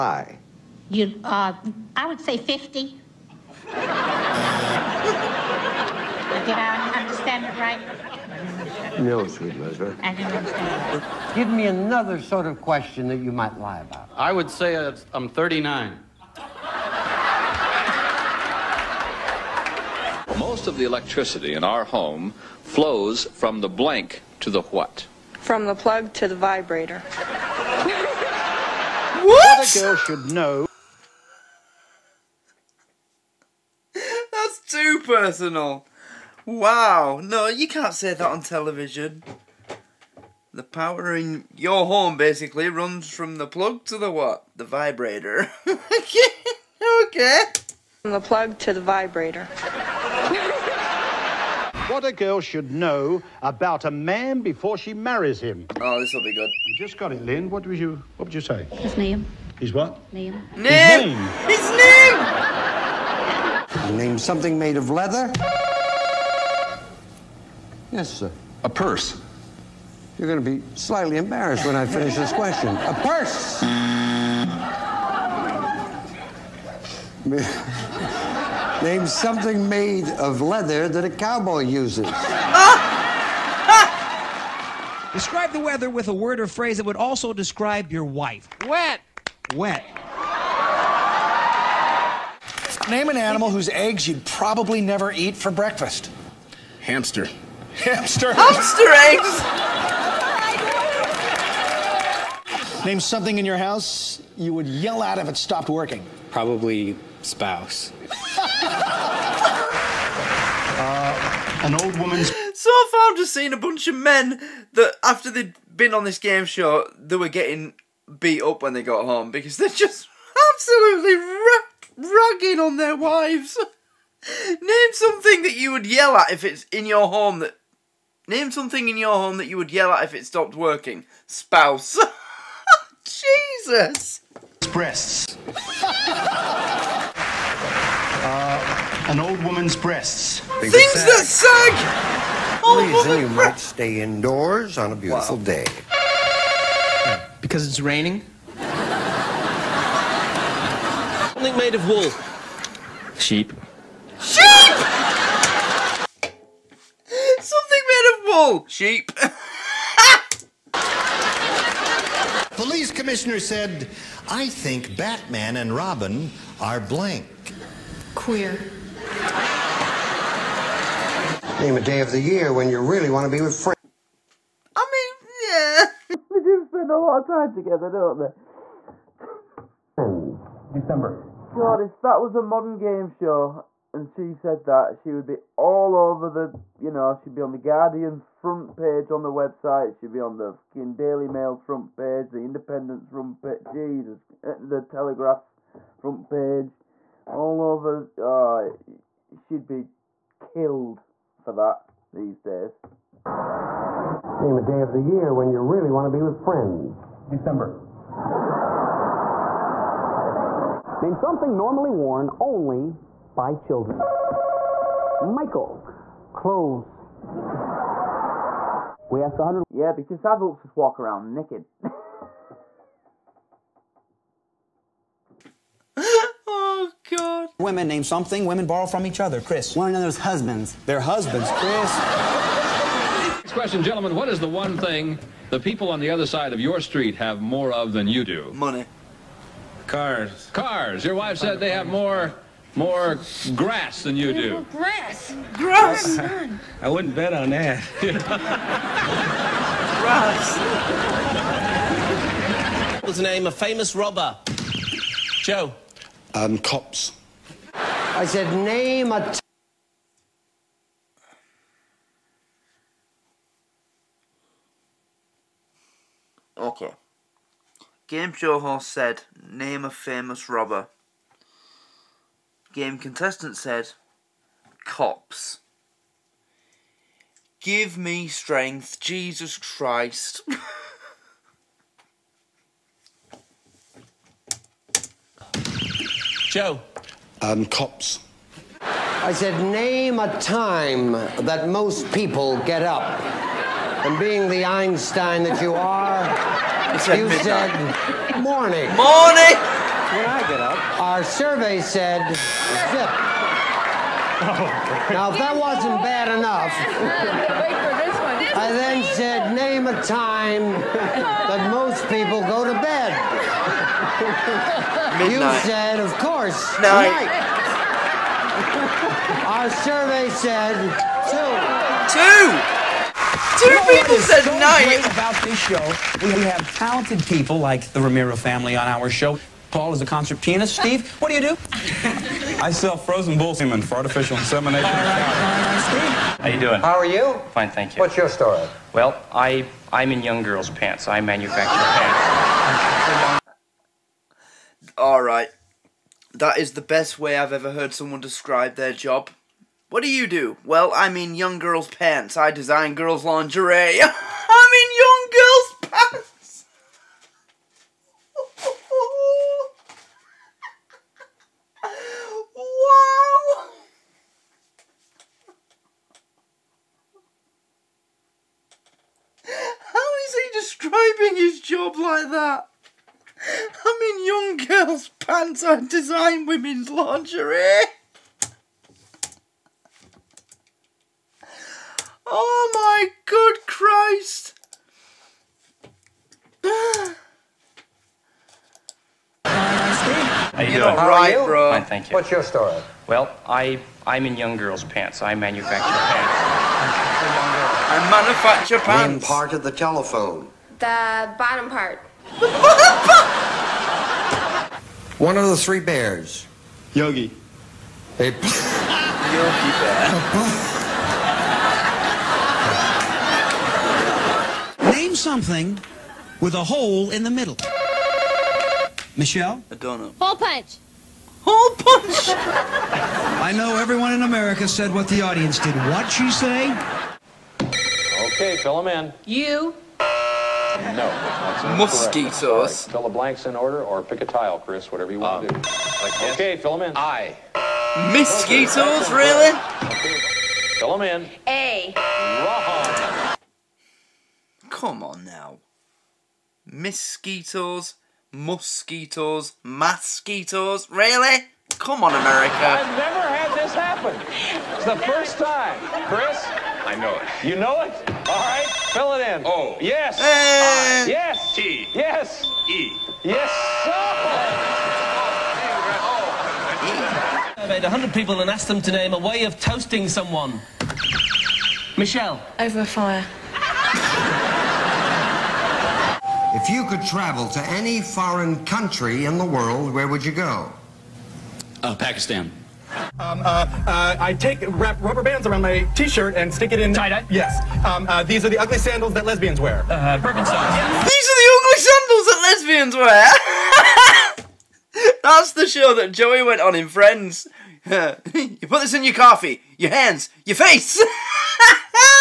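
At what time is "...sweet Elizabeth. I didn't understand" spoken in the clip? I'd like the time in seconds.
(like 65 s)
9 s.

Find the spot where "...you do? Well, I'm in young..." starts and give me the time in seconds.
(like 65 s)
350 s.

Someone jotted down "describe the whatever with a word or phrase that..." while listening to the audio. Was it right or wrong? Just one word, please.
wrong.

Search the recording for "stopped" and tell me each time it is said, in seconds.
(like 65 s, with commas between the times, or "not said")
105 s, 130 s.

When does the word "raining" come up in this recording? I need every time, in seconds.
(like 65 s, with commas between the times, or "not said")
147 s.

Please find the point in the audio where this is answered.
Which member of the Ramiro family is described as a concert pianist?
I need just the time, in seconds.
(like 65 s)
329 s.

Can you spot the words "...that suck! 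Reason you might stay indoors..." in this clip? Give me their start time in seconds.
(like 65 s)
140 s.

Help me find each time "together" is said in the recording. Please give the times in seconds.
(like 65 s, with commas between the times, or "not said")
177 s.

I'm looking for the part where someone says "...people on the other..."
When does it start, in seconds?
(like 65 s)
235 s.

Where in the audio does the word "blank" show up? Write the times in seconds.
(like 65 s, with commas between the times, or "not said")
23 s, 166 s, 433 s.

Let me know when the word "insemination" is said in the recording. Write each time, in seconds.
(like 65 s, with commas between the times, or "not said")
334 s.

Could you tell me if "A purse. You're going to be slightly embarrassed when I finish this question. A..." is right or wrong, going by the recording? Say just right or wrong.
right.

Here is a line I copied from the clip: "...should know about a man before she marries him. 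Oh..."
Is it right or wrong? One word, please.
right.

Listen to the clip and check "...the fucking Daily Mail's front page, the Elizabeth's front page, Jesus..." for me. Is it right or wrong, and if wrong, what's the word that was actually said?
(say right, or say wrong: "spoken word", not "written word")
wrong: "Independent", not "Elizabeth".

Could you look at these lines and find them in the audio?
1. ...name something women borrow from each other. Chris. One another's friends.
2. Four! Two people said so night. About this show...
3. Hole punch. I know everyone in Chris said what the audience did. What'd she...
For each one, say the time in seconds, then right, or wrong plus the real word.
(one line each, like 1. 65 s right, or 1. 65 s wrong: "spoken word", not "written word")
1. 227 s wrong: "husbands", not "friends"
2. 322 s wrong: "Two", not "Four"
3. 421 s wrong: "America", not "Chris".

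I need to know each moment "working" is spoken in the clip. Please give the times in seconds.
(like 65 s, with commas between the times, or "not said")
105 s, 130 s.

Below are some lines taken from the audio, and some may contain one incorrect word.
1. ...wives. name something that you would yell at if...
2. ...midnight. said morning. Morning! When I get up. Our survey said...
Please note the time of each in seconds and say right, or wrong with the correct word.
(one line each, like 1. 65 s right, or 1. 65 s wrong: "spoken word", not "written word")
1. 122 s right
2. 297 s right.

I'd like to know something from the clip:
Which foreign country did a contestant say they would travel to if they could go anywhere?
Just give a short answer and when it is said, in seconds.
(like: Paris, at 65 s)
Pakistan, at 481 s.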